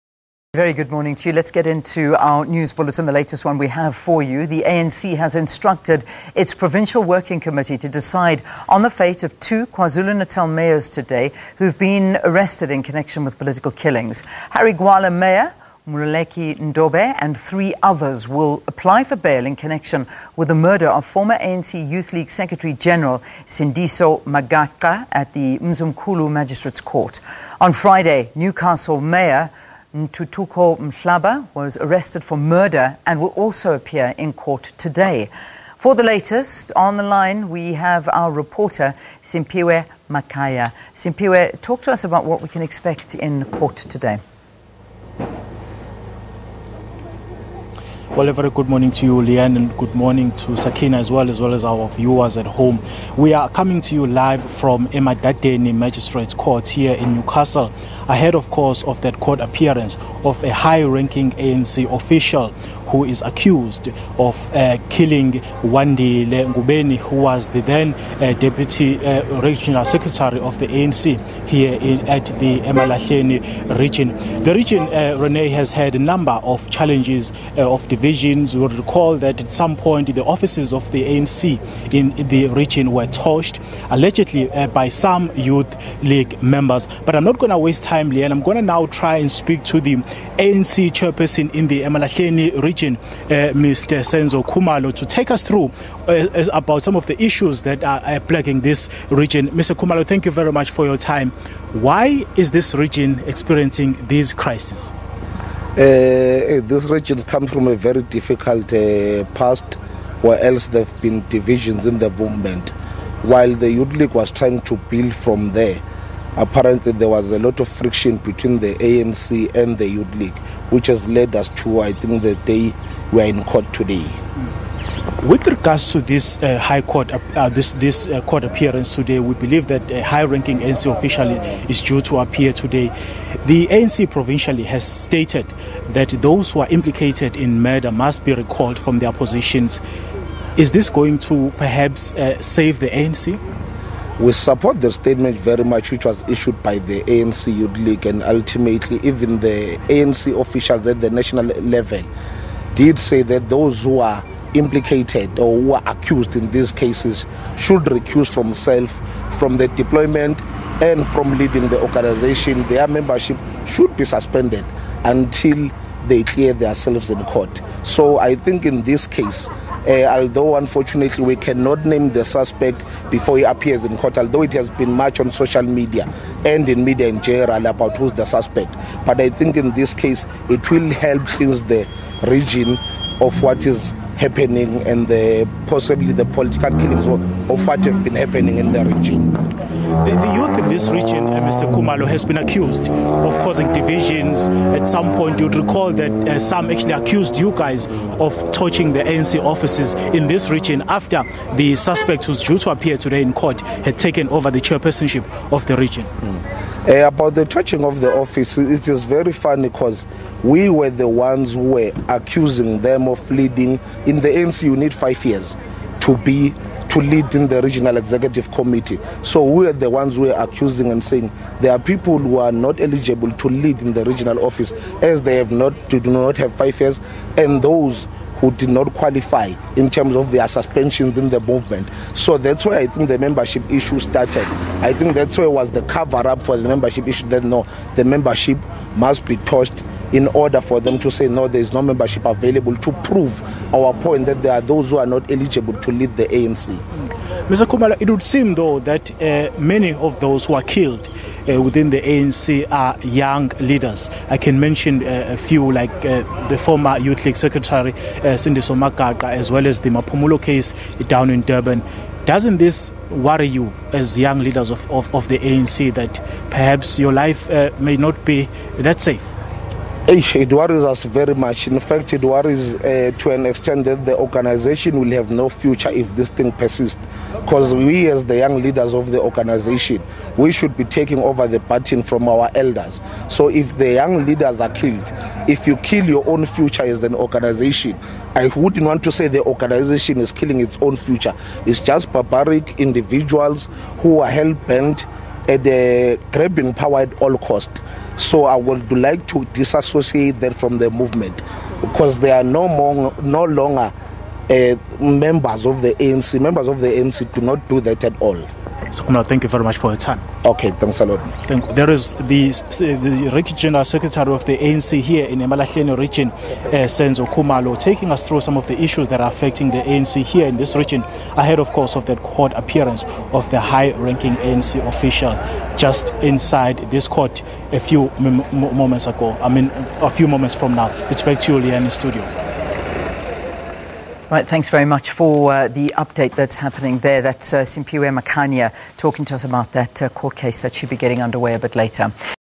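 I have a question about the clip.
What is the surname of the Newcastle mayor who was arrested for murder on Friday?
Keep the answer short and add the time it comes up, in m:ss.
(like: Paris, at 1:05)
Mahlaba, at 0:30.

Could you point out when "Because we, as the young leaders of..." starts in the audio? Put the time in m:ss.
4:37.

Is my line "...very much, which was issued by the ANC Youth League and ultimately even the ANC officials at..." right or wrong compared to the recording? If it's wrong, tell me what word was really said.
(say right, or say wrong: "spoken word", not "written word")
right.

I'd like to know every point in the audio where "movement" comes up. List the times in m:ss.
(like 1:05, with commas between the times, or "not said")
1:52, 3:51, 5:00.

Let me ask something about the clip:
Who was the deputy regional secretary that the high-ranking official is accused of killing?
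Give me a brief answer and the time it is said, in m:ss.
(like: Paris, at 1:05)
Wandile Ngubeni, at 1:05.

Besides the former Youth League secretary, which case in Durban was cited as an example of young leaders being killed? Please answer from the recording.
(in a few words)
Mapumulo.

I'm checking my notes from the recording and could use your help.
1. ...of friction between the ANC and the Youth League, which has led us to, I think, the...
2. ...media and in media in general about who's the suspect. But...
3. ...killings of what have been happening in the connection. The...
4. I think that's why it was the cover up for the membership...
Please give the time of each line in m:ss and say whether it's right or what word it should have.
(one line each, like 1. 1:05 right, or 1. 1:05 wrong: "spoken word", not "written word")
1. 1:57 right
2. 2:55 right
3. 3:06 wrong: "region", not "connection"
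4. 3:54 right.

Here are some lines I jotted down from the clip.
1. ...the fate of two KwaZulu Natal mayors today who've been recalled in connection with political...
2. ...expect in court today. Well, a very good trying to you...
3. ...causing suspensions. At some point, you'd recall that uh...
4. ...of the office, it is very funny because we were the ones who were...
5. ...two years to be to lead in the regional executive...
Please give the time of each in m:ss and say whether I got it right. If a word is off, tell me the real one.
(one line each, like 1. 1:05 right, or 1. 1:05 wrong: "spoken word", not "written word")
1. 0:08 wrong: "arrested", not "recalled"
2. 0:42 wrong: "morning", not "trying"
3. 3:13 wrong: "divisions", not "suspensions"
4. 3:27 right
5. 3:34 wrong: "five", not "two".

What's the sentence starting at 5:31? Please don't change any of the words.
It's back to you, Leanne, in studio.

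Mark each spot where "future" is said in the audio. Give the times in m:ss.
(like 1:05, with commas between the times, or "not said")
4:35, 4:46, 4:50.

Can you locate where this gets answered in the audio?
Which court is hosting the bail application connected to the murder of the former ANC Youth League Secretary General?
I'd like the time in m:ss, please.
0:25.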